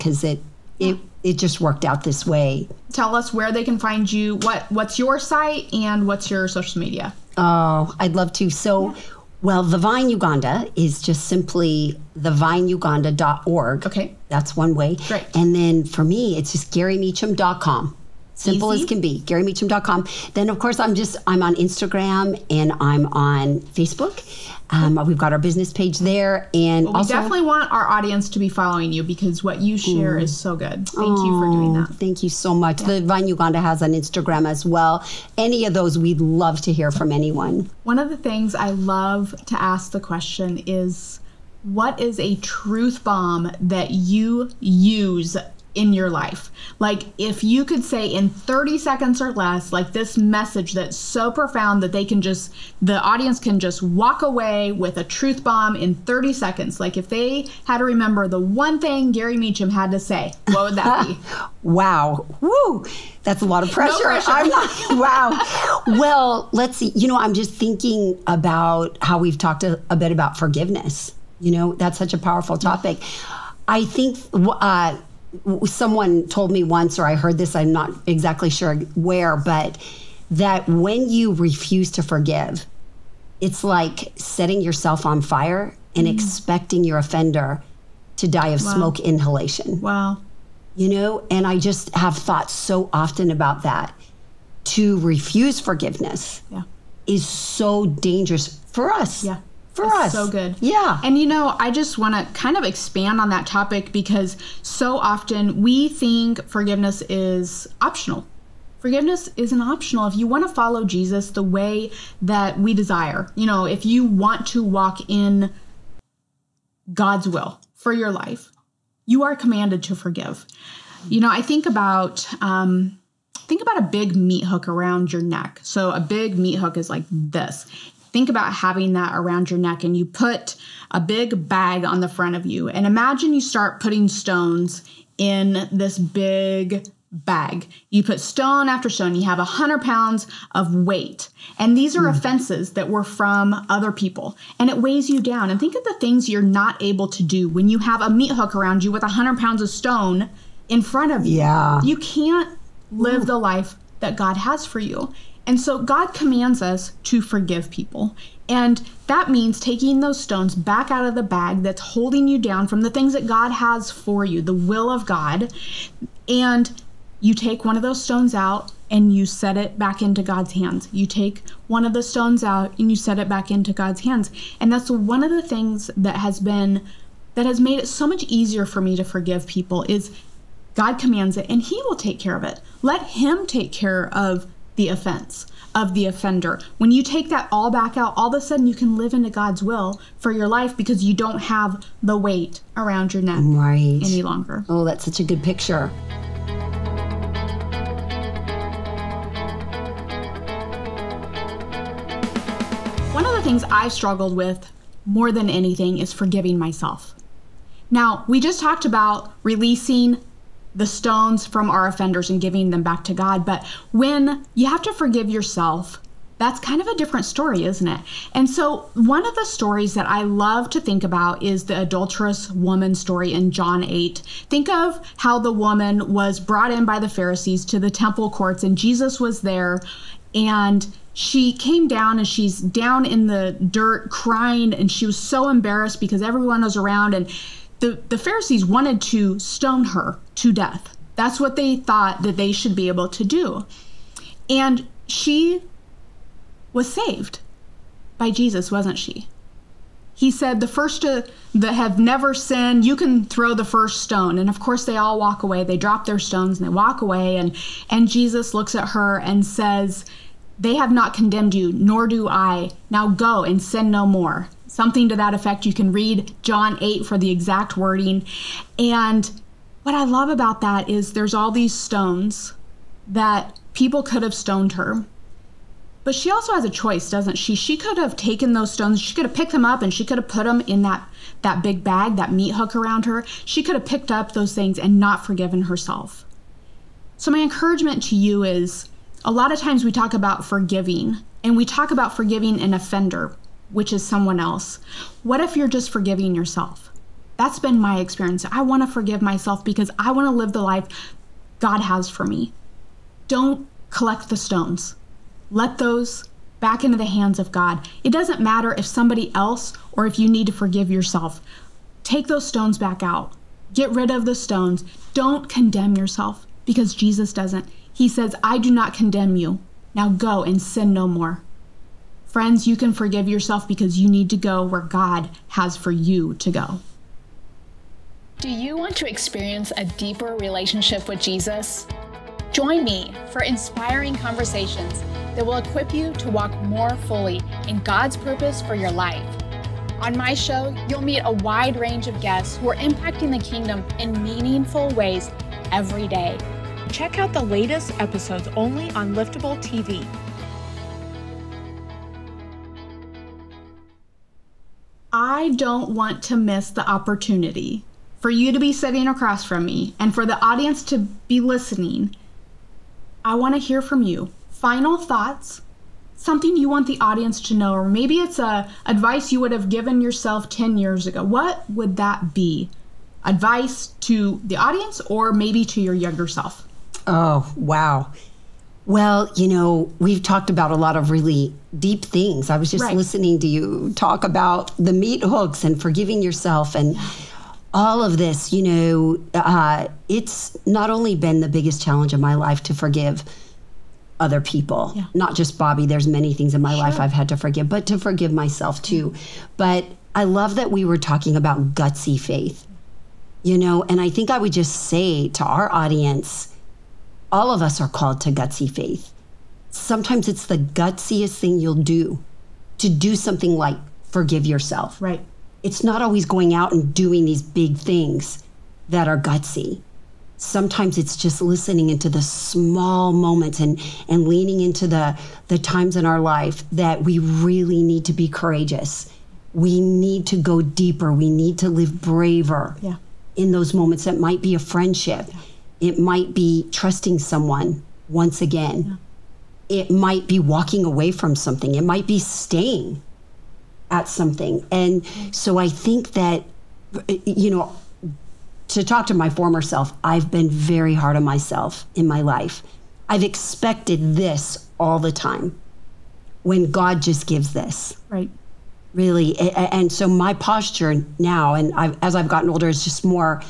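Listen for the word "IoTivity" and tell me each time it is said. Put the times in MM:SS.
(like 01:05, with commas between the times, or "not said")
not said.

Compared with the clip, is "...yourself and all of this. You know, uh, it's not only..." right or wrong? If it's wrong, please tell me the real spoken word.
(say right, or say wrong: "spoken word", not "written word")
right.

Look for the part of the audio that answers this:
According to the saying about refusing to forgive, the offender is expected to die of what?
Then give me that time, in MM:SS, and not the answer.
01:28.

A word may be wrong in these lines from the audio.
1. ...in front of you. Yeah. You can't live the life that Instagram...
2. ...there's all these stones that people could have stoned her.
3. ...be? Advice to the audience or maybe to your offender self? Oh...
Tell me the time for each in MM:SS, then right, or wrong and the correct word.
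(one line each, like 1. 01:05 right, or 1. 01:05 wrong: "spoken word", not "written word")
1. 02:30 wrong: "God", not "Instagram"
2. 04:31 right
3. 06:12 wrong: "younger", not "offender".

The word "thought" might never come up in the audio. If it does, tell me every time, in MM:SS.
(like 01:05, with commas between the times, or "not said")
01:32, 04:01, 06:04.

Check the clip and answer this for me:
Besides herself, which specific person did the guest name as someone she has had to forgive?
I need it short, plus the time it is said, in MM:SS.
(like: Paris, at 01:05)
Bobby, at 06:35.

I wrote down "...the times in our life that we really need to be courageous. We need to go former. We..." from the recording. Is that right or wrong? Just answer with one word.
wrong.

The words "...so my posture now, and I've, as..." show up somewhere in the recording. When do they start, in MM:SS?
07:39.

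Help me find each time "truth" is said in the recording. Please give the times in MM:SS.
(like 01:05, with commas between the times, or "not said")
00:42, 00:55.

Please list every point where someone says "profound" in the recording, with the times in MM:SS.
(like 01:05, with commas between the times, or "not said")
00:51.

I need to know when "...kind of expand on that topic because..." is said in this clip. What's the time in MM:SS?
01:42.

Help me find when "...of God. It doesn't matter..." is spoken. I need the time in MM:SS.
05:07.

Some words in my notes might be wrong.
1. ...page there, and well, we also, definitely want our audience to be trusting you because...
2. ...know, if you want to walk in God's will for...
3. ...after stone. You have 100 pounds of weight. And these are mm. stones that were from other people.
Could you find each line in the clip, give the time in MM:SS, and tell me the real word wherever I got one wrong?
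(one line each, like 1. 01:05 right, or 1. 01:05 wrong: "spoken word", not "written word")
1. 00:25 wrong: "following", not "trusting"
2. 01:53 right
3. 02:18 wrong: "offenses", not "stones".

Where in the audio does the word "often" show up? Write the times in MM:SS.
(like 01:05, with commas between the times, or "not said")
01:32, 01:44.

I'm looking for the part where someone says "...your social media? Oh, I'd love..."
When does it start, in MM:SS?
00:06.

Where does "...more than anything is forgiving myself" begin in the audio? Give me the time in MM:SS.
03:25.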